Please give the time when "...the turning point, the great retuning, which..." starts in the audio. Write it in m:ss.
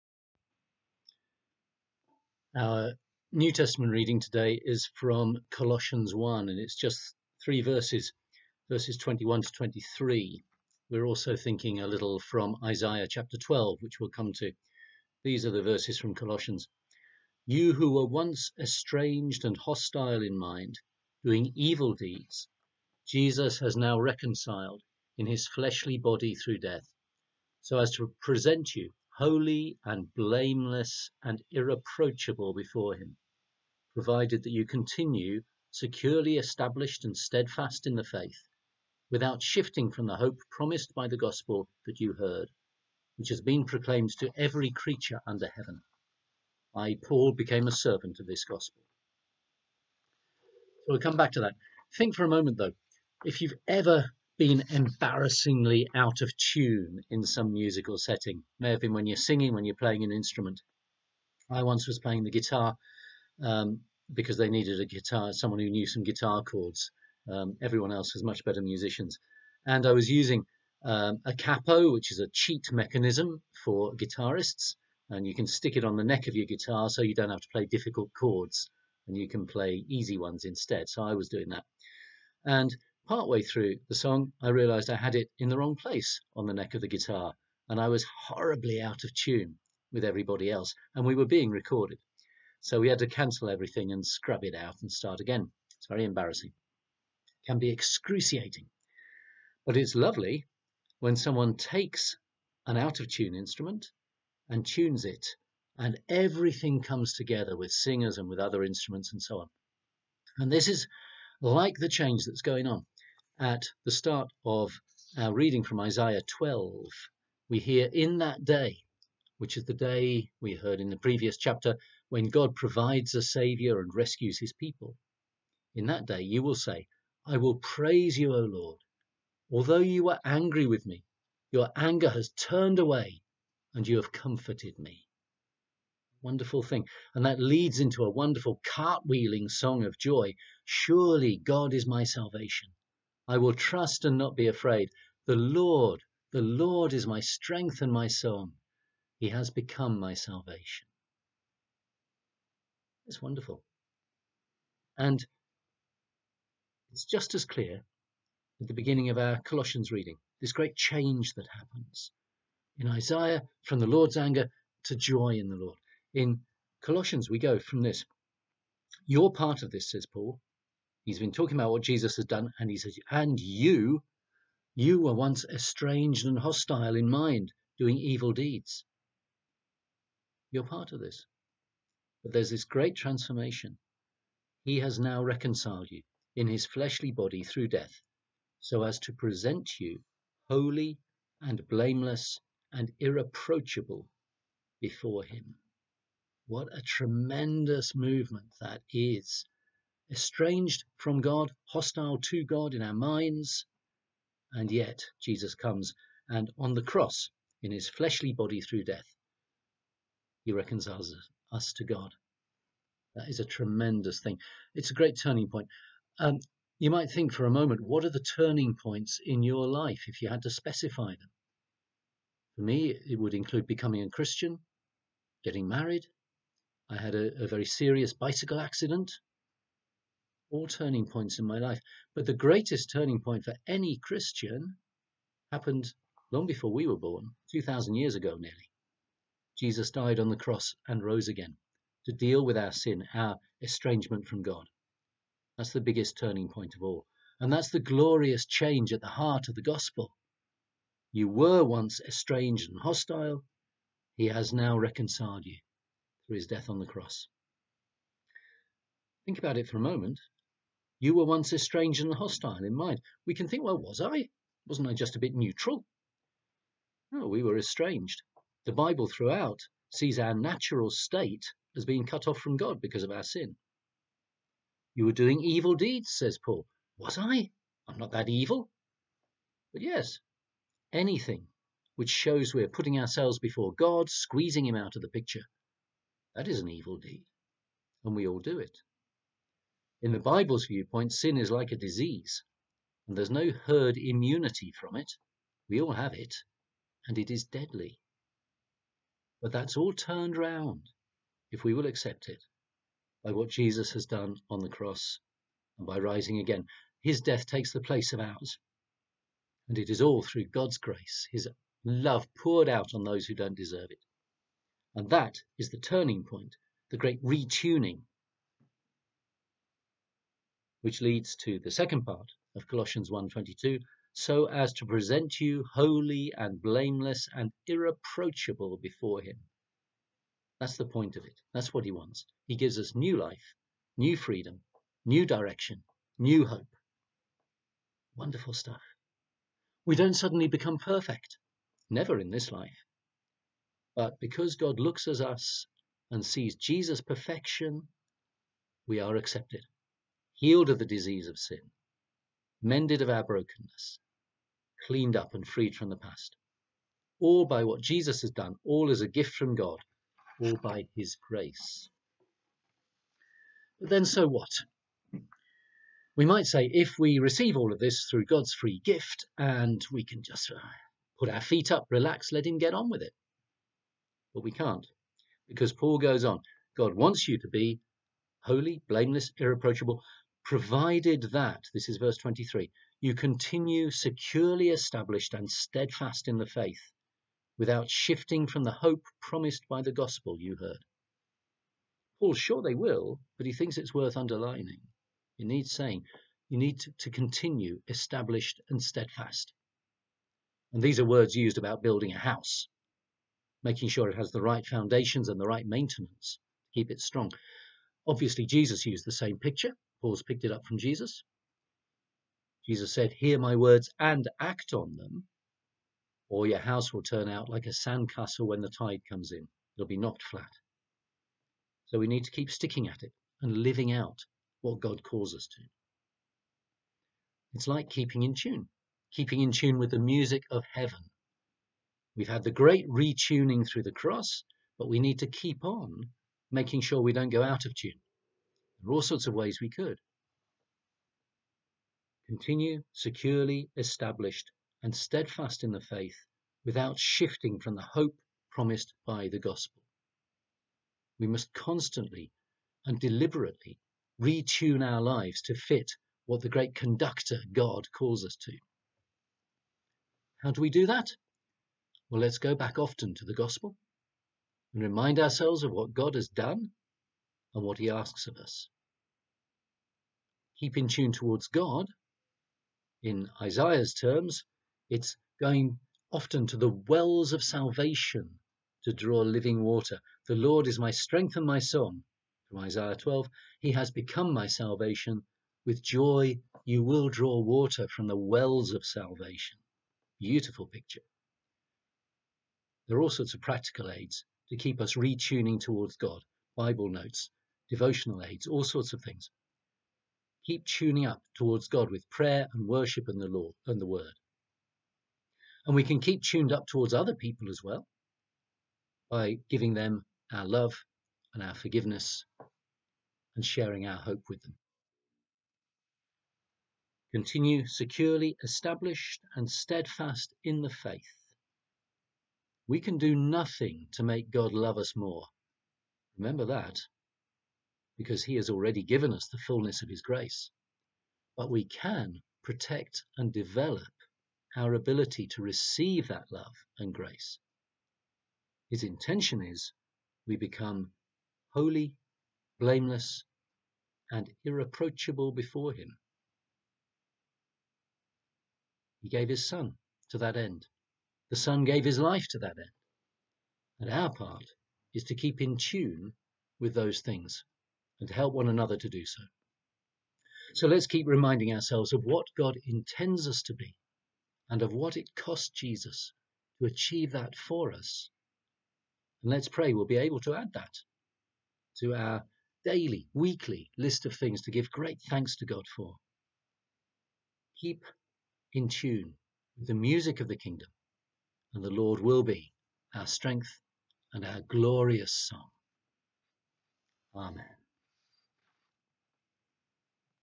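5:15.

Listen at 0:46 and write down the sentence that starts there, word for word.
I, Paul, became a servant of this gospel.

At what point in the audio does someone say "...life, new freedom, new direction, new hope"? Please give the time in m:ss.
5:33.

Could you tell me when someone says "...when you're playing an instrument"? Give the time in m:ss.
0:59.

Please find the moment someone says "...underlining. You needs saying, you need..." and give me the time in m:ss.
6:34.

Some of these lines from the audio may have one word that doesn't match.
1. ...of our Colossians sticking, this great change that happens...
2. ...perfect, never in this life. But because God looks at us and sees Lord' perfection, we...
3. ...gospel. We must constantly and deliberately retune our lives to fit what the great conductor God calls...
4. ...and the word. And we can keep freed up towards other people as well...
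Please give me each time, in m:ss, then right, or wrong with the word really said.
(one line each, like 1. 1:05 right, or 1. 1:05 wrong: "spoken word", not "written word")
1. 2:39 wrong: "reading", not "sticking"
2. 5:40 wrong: "Jesus", not "Lord"
3. 7:29 right
4. 8:23 wrong: "tuned", not "freed".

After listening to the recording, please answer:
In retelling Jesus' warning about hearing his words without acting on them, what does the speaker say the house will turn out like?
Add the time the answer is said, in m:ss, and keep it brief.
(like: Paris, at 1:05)
A sandcastle, at 6:57.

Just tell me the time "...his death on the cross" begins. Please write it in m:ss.
4:16.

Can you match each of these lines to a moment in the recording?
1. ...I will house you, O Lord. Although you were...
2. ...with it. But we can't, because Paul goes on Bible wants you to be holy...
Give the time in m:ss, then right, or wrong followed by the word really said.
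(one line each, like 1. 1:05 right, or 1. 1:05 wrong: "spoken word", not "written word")
1. 2:07 wrong: "praise", not "house"
2. 6:12 wrong: "God", not "Bible".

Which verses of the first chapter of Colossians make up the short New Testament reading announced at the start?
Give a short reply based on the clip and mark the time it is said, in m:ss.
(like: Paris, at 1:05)
21 to 23, at 0:08.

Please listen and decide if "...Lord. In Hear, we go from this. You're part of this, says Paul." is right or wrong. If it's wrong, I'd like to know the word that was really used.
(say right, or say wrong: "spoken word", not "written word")
wrong: "Colossians", not "Hear".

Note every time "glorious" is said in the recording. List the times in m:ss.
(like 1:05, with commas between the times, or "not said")
4:07, 9:44.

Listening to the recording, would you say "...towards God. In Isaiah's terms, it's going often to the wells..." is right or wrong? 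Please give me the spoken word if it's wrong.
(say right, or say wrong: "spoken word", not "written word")
right.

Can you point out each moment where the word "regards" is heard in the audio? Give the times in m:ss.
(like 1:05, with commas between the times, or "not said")
not said.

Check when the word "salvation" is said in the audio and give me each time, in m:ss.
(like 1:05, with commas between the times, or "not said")
2:22, 2:30, 7:57, 8:04, 8:08.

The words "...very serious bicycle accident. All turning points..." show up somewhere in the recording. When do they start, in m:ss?
3:47.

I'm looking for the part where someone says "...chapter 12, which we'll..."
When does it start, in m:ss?
0:13.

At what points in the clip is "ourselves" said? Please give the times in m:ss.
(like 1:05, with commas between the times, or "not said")
4:43, 7:45, 9:21.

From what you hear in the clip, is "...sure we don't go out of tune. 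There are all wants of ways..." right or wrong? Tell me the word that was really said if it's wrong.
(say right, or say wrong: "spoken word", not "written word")
wrong: "sorts", not "wants".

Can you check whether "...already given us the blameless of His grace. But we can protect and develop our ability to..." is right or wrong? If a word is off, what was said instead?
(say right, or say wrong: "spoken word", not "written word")
wrong: "fullness", not "blameless".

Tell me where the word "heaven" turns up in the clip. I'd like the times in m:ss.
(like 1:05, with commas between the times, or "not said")
0:45, 7:10.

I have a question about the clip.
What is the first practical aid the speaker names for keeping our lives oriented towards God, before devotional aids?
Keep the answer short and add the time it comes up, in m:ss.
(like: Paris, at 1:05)
Bible notes, at 8:16.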